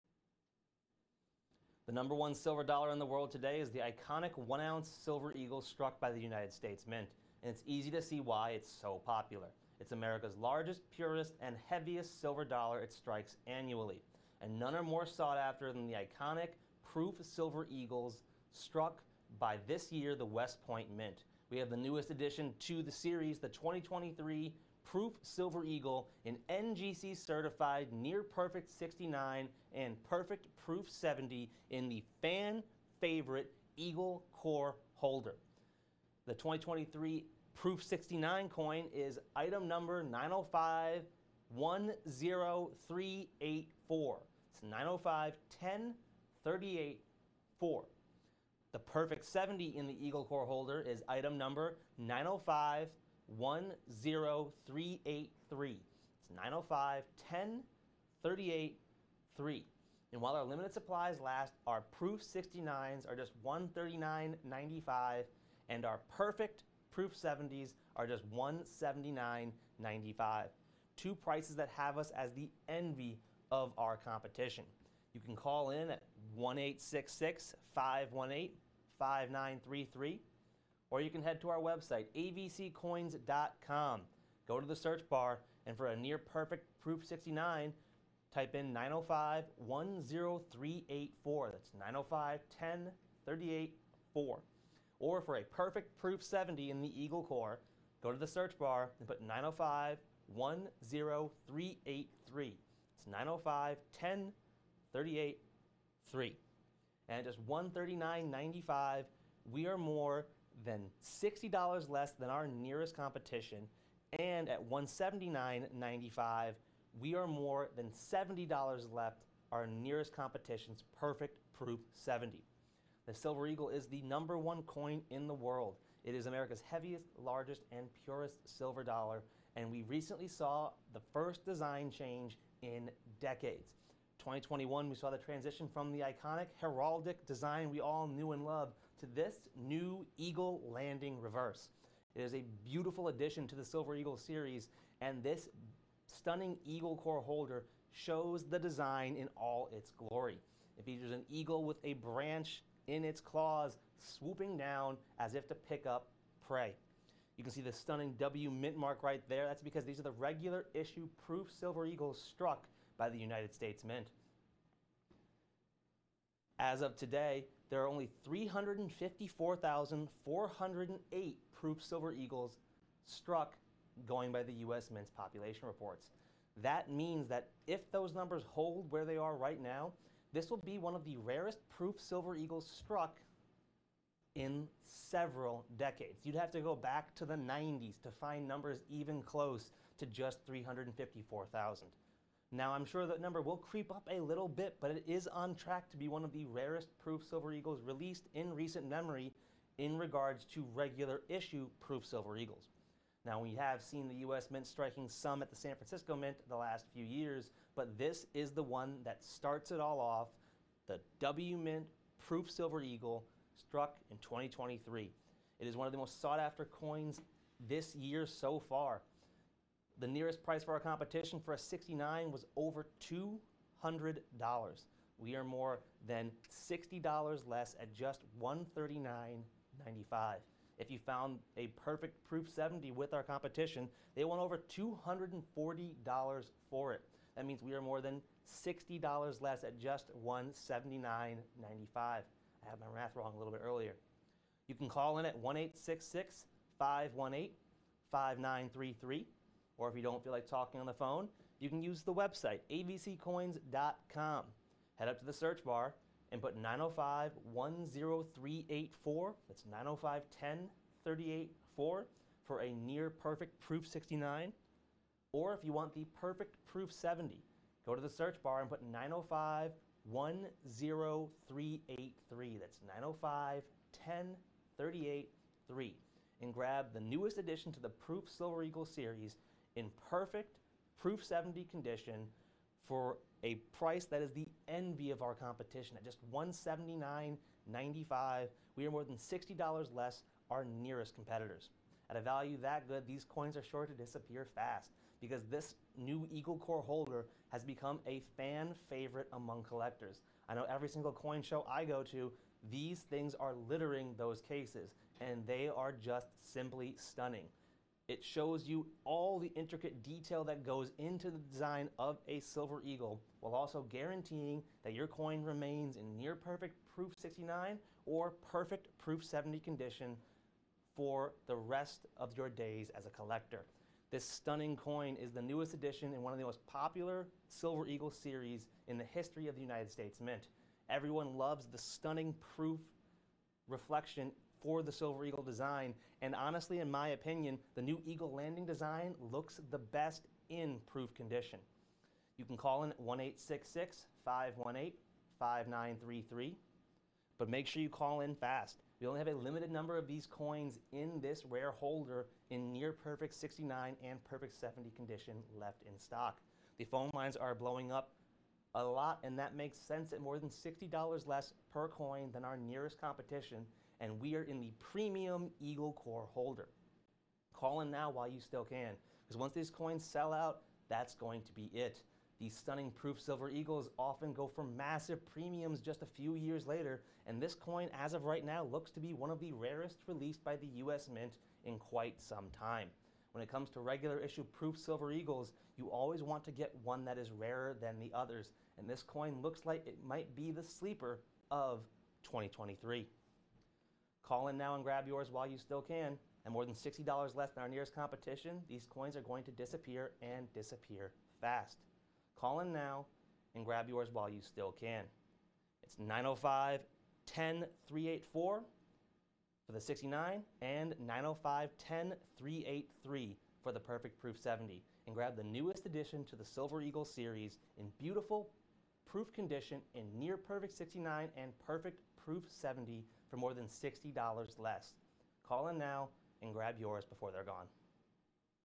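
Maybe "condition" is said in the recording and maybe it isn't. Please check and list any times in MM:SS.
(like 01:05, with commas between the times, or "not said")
04:41, 05:19, 05:41, 05:54, 06:59.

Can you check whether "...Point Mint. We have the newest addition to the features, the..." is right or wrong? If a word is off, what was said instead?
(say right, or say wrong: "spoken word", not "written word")
wrong: "series", not "features".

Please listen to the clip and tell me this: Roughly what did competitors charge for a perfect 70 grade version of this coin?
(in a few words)
over $240.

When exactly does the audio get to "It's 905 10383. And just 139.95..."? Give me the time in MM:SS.
01:42.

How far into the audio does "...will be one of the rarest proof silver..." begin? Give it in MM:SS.
03:00.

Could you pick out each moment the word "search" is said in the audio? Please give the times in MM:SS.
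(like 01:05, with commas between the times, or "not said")
01:24, 01:38, 04:15, 04:28.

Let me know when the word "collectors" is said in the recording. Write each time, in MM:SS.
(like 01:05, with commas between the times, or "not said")
04:59, 05:23.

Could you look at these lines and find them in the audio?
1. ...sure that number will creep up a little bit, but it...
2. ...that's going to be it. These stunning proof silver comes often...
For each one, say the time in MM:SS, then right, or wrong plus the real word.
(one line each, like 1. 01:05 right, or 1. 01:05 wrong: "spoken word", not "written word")
1. 03:12 right
2. 06:10 wrong: "eagles", not "comes".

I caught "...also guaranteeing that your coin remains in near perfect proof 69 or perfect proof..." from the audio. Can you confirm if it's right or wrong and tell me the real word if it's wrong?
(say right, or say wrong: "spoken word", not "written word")
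right.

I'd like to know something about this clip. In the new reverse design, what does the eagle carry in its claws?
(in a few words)
a branch.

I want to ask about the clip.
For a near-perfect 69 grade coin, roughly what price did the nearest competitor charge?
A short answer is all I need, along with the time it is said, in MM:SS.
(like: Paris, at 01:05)
over $200, at 03:42.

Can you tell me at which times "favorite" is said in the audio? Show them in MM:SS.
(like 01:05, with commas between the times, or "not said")
00:32, 04:58.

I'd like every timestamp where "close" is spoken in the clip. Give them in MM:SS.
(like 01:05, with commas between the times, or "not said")
03:09.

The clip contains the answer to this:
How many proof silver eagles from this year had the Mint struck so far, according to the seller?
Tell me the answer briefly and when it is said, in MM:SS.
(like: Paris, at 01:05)
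354,408, at 02:48.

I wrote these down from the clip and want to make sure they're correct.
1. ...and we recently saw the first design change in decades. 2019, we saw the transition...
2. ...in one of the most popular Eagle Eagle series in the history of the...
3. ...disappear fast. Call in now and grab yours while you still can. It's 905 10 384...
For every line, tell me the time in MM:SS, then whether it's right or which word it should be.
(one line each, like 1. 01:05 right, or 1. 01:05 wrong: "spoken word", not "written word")
1. 02:09 wrong: "2021", not "2019"
2. 05:26 wrong: "Silver", not "Eagle"
3. 06:40 right.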